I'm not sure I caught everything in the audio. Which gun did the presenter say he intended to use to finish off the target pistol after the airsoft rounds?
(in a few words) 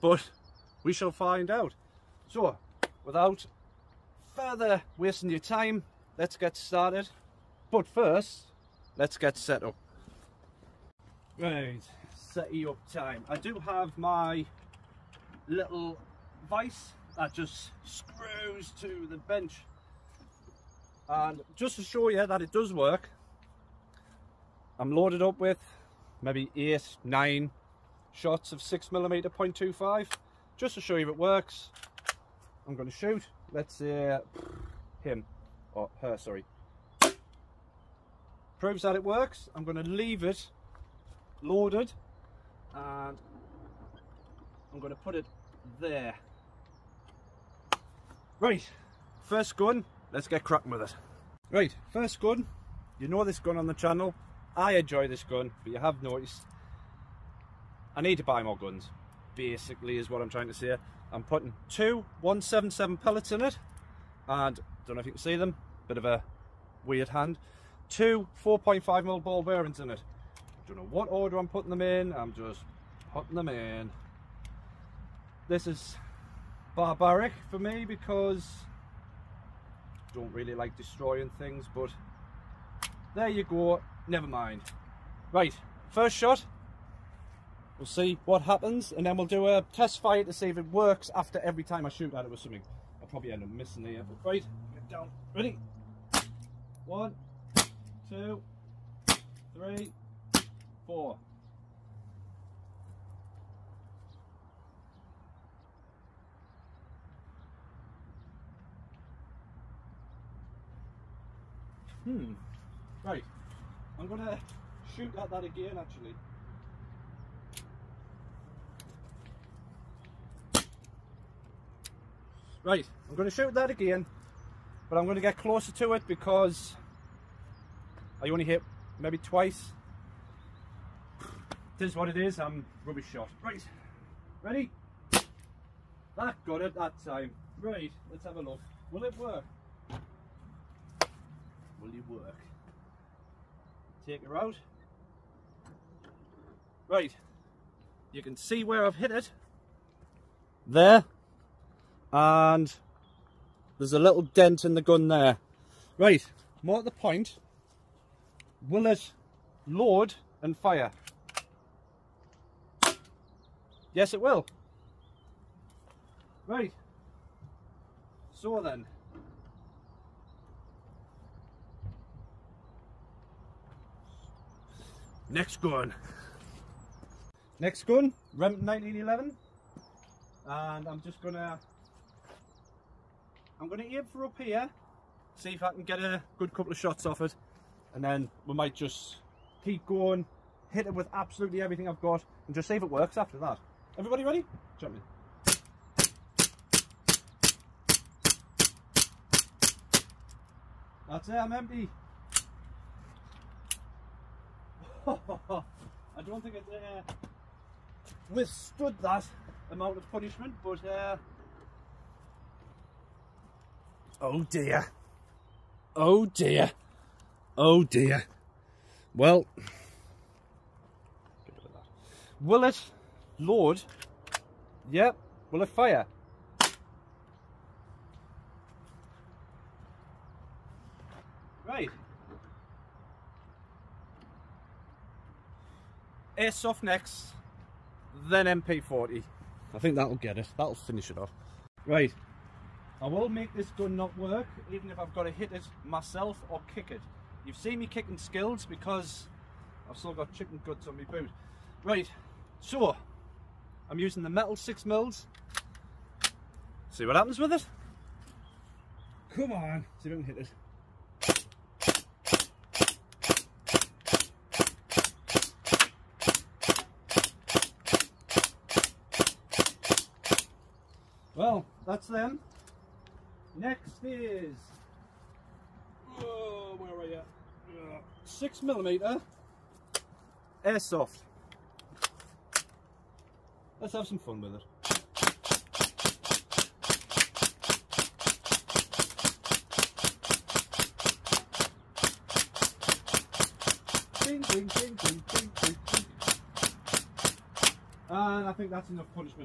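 MP40.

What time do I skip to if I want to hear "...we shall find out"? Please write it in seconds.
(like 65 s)
0 s.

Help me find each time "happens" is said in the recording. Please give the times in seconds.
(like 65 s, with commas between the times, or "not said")
88 s, 257 s.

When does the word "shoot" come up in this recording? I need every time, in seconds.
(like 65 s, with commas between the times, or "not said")
32 s, 91 s, 114 s, 123 s.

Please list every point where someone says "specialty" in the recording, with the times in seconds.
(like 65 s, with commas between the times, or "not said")
not said.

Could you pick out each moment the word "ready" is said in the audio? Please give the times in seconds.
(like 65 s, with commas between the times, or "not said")
95 s, 134 s, 194 s.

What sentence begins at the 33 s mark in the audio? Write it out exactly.
Let's see uh, him or her, sorry.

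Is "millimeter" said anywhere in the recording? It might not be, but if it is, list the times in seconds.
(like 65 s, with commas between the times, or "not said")
28 s, 278 s.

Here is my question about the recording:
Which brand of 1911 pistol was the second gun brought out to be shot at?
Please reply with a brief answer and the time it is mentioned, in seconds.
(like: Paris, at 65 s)
Remington, at 178 s.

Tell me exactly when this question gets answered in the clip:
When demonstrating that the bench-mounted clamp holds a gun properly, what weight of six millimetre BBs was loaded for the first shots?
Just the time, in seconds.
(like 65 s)
29 s.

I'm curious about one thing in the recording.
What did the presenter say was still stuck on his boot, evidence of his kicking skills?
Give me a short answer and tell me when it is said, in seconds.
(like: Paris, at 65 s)
chicken guts, at 250 s.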